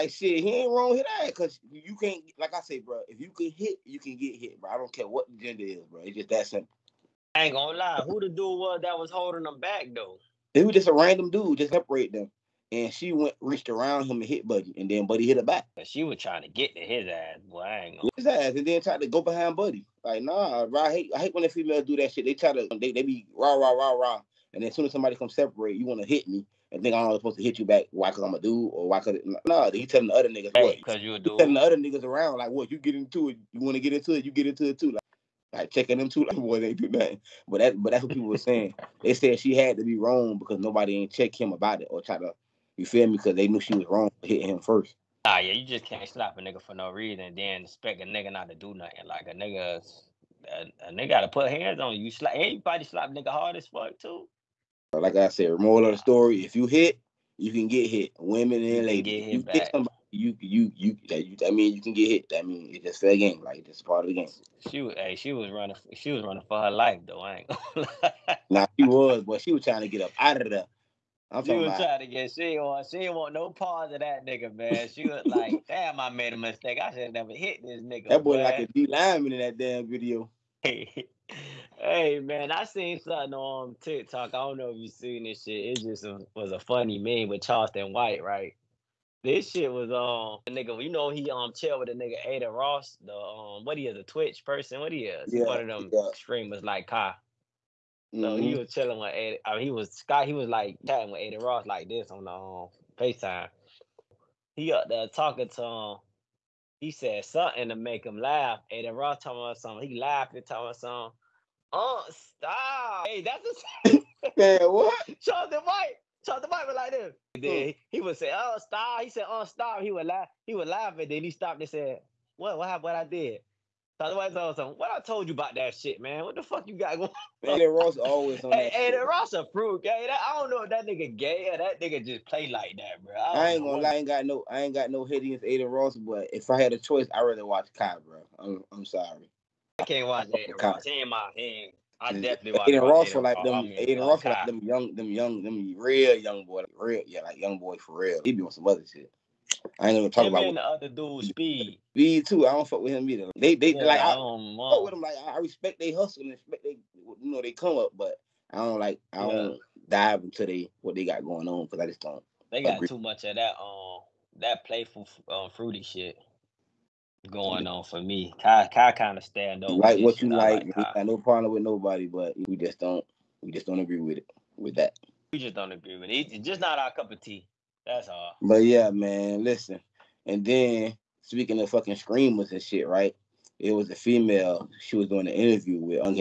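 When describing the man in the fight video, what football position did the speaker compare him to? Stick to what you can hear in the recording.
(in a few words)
D lineman.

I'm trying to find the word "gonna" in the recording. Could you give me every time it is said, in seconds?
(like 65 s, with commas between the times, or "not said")
7 s, 17 s, 67 s, 133 s.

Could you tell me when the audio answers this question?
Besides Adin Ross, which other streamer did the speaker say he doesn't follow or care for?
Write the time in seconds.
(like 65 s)
151 s.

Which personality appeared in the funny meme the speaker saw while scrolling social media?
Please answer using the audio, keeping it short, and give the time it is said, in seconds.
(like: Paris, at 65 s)
Charleston White, at 87 s.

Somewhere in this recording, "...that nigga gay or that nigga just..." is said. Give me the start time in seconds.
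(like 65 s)
130 s.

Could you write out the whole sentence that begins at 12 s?
And she went reached around him and hit Buddy, and then Buddy hit her back.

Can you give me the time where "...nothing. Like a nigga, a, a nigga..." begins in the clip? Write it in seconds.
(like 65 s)
48 s.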